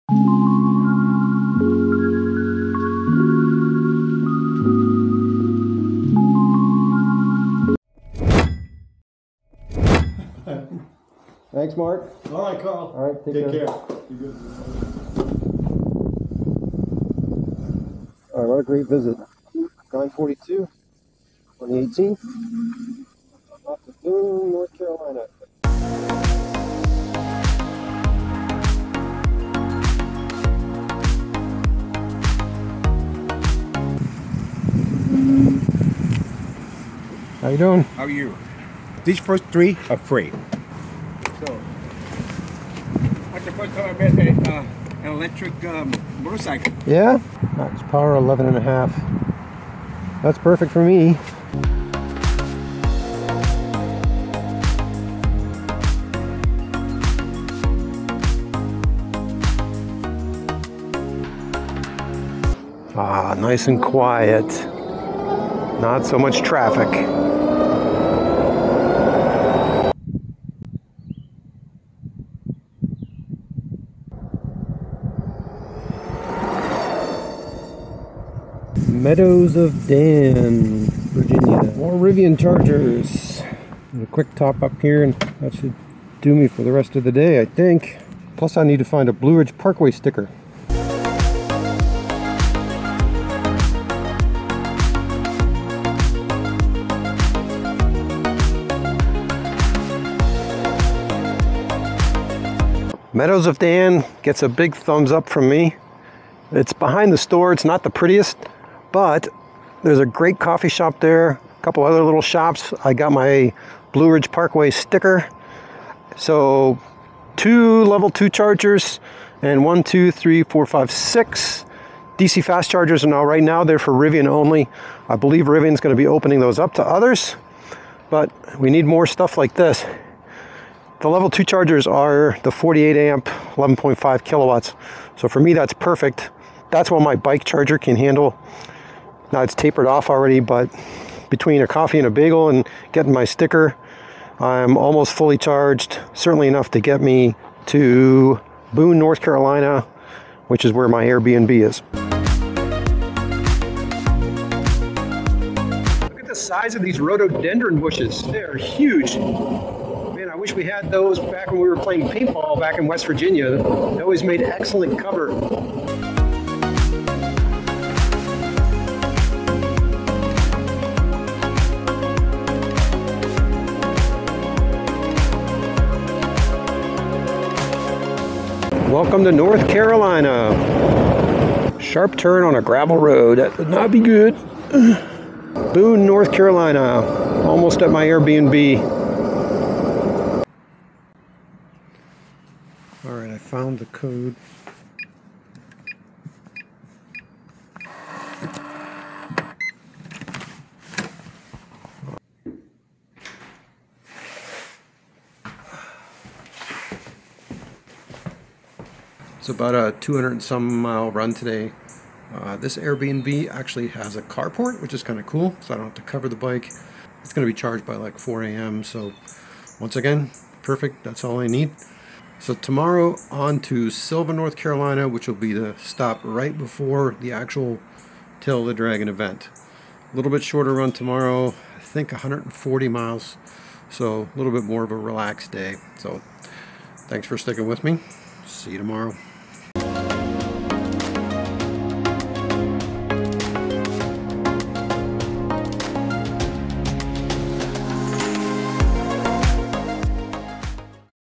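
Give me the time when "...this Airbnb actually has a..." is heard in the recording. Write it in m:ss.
3:32.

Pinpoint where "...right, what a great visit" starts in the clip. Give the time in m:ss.
0:18.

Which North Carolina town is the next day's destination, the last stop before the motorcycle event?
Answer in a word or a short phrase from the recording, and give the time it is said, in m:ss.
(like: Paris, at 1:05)
Sylva, at 3:43.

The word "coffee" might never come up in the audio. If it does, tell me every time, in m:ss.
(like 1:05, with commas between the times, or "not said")
1:50, 2:21.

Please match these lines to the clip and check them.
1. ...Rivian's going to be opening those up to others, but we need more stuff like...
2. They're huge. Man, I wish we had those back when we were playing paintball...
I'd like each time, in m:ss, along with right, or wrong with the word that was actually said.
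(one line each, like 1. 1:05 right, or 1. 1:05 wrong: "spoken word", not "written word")
1. 2:05 right
2. 2:38 right.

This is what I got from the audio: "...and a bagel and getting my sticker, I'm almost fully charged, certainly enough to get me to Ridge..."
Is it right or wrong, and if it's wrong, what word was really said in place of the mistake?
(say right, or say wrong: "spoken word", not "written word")
wrong: "Boone", not "Ridge".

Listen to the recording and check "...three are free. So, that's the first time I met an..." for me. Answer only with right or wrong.
right.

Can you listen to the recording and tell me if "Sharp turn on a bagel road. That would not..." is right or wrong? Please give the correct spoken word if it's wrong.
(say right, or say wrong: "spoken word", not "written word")
wrong: "gravel", not "bagel".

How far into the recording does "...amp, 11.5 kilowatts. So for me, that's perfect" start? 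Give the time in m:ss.
2:12.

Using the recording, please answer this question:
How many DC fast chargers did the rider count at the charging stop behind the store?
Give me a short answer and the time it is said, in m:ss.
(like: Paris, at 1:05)
6, at 2:00.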